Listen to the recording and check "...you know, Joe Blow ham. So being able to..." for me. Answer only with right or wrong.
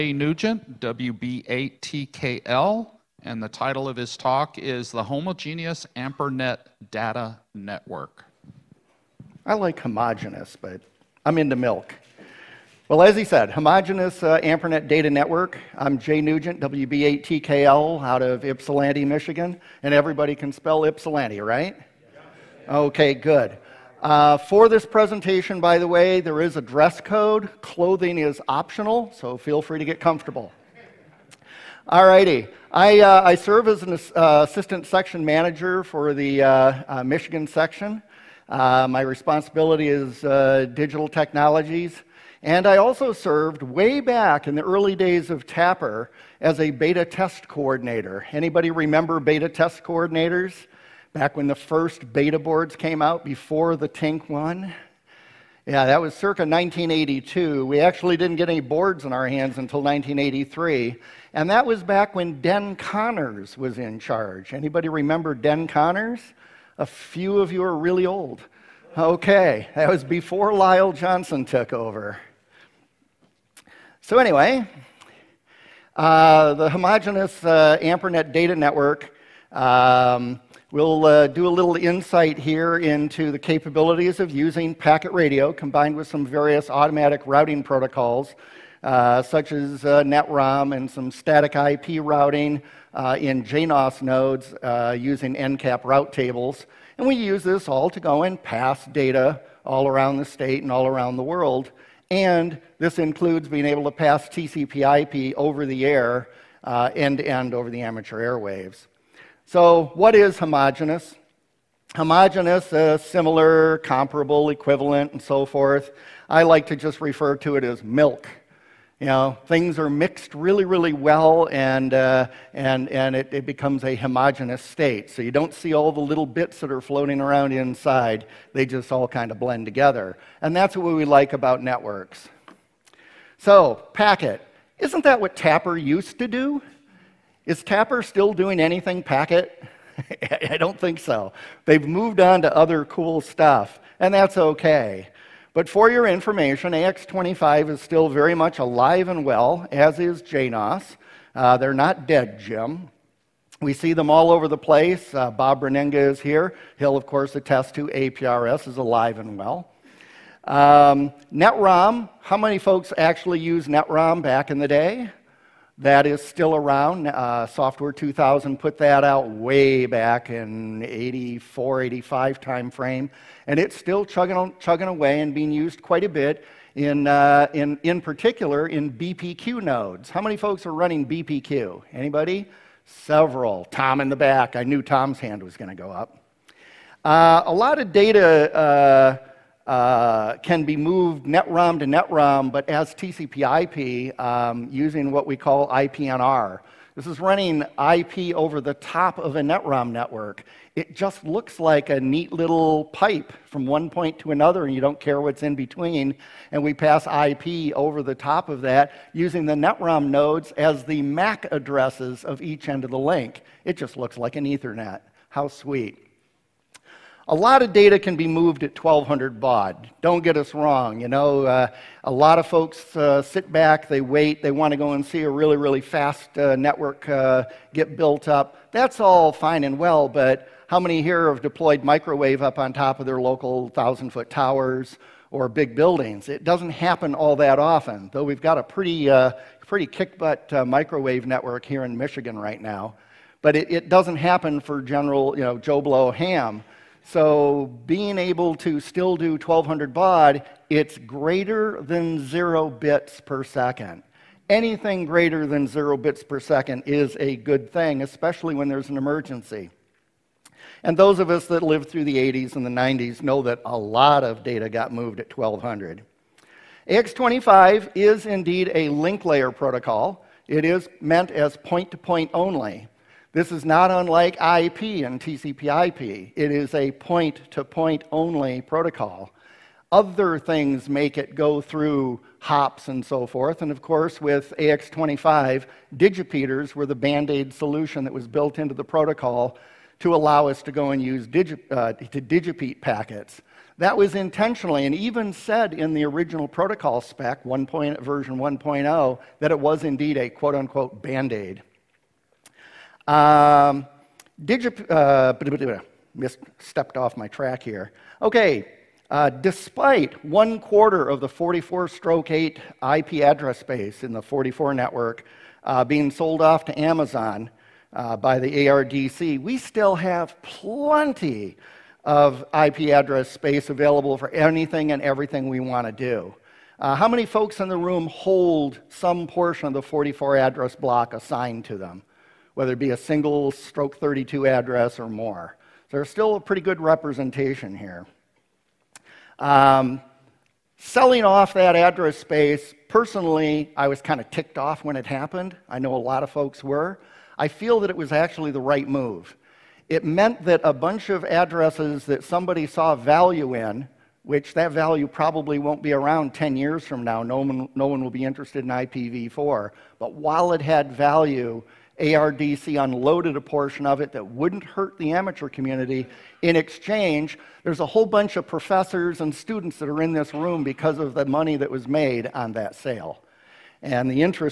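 right.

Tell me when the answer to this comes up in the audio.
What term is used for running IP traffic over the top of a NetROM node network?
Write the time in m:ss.
3:15.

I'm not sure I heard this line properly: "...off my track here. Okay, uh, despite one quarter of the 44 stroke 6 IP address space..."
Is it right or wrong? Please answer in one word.
wrong.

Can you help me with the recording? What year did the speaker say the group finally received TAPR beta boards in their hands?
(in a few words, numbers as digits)
1983.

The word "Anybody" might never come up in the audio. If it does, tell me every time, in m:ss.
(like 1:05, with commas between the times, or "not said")
0:48, 1:04, 3:01.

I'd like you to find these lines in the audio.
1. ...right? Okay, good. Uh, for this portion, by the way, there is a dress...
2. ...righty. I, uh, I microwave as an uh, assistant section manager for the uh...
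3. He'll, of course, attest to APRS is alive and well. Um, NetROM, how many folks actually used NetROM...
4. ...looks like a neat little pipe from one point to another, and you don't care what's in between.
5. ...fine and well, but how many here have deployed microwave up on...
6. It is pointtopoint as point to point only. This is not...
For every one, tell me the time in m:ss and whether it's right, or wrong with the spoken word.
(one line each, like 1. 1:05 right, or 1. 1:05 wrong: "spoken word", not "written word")
1. 0:21 wrong: "presentation", not "portion"
2. 0:32 wrong: "serve", not "microwave"
3. 2:36 right
4. 3:21 right
5. 3:49 right
6. 4:30 wrong: "meant", not "pointtopoint".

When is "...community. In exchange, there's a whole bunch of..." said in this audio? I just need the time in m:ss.
6:05.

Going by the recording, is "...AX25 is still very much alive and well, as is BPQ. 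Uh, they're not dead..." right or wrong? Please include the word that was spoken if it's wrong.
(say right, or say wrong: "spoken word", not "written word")
wrong: "JNOS", not "BPQ".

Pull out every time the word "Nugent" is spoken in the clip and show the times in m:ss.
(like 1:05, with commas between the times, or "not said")
0:00, 0:16.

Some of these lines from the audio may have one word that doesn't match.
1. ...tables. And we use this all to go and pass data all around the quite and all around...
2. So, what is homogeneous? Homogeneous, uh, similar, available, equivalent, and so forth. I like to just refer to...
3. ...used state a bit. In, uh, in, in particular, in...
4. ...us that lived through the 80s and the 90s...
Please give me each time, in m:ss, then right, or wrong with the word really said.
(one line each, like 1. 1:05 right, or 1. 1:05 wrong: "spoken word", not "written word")
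1. 1:36 wrong: "state", not "quite"
2. 1:49 wrong: "comparable", not "available"
3. 2:55 wrong: "quite", not "state"
4. 4:21 right.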